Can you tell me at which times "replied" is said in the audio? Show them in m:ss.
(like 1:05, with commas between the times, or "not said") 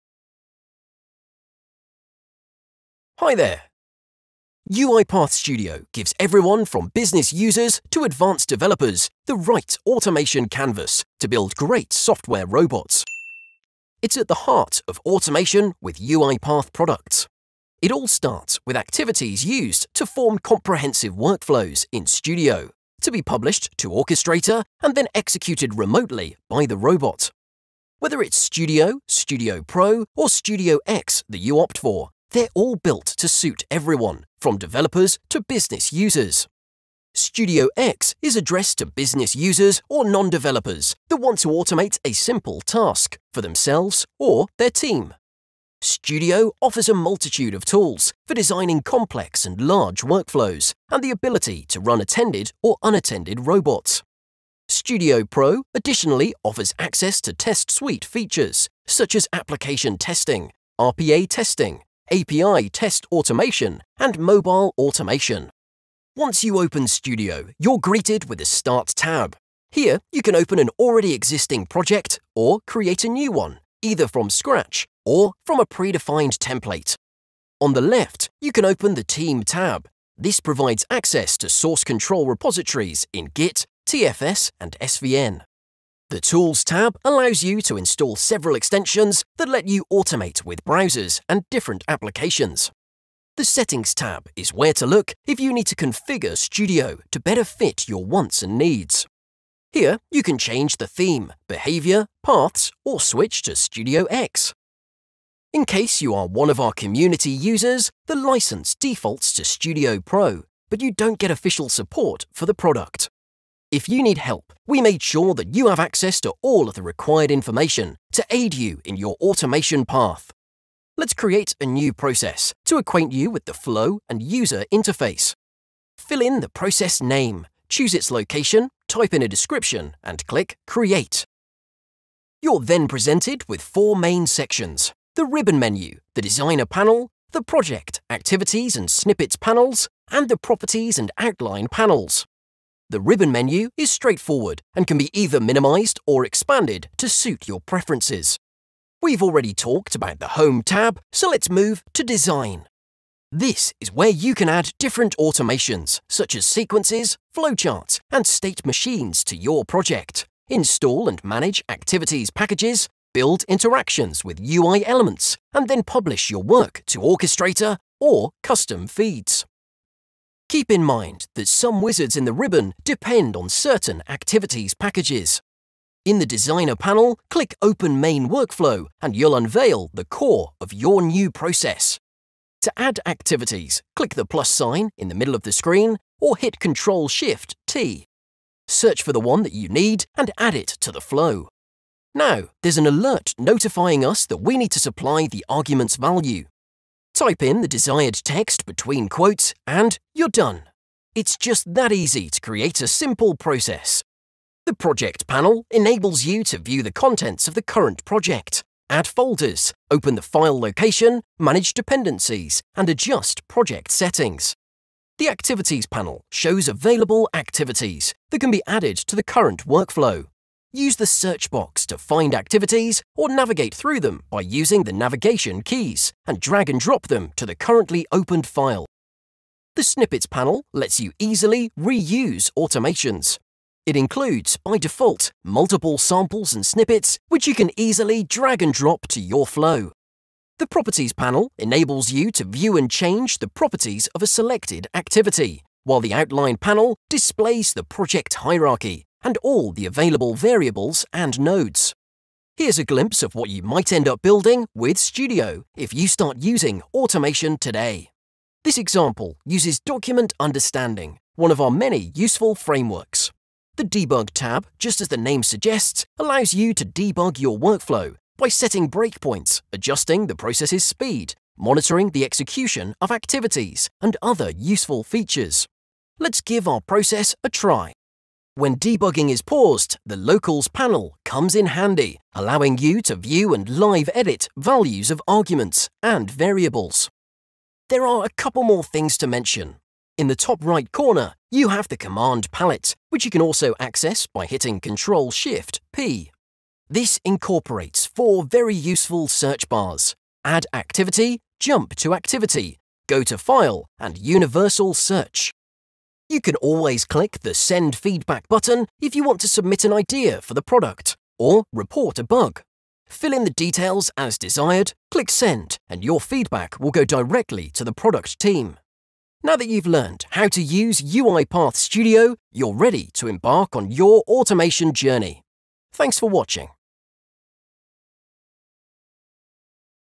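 not said.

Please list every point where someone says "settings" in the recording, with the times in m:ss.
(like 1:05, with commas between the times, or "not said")
1:33, 3:33, 4:28.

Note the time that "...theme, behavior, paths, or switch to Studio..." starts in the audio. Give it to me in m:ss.
1:40.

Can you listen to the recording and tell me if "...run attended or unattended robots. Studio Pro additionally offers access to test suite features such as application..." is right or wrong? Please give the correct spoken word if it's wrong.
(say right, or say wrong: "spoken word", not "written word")
right.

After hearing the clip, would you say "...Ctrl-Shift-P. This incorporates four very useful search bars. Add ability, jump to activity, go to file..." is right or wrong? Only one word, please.
wrong.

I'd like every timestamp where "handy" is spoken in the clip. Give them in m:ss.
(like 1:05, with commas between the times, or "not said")
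4:41.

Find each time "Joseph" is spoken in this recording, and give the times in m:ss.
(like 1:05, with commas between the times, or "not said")
not said.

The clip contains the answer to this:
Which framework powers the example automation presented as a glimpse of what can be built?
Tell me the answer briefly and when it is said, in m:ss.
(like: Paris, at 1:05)
Document Understanding, at 4:19.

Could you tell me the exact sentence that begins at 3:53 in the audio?
It includes, by default, multiple samples and snippets which you can easily drag and drop to your flow.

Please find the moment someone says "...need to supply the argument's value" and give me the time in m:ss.
3:14.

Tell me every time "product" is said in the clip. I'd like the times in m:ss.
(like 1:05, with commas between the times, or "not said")
0:16, 1:52, 5:10, 5:17.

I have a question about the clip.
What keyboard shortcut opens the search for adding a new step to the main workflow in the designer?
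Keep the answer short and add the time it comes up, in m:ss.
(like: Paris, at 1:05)
Ctrl-Shift-T, at 3:06.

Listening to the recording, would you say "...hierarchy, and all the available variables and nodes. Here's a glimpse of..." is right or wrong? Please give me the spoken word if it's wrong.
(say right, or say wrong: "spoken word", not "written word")
right.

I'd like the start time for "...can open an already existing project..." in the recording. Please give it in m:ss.
1:10.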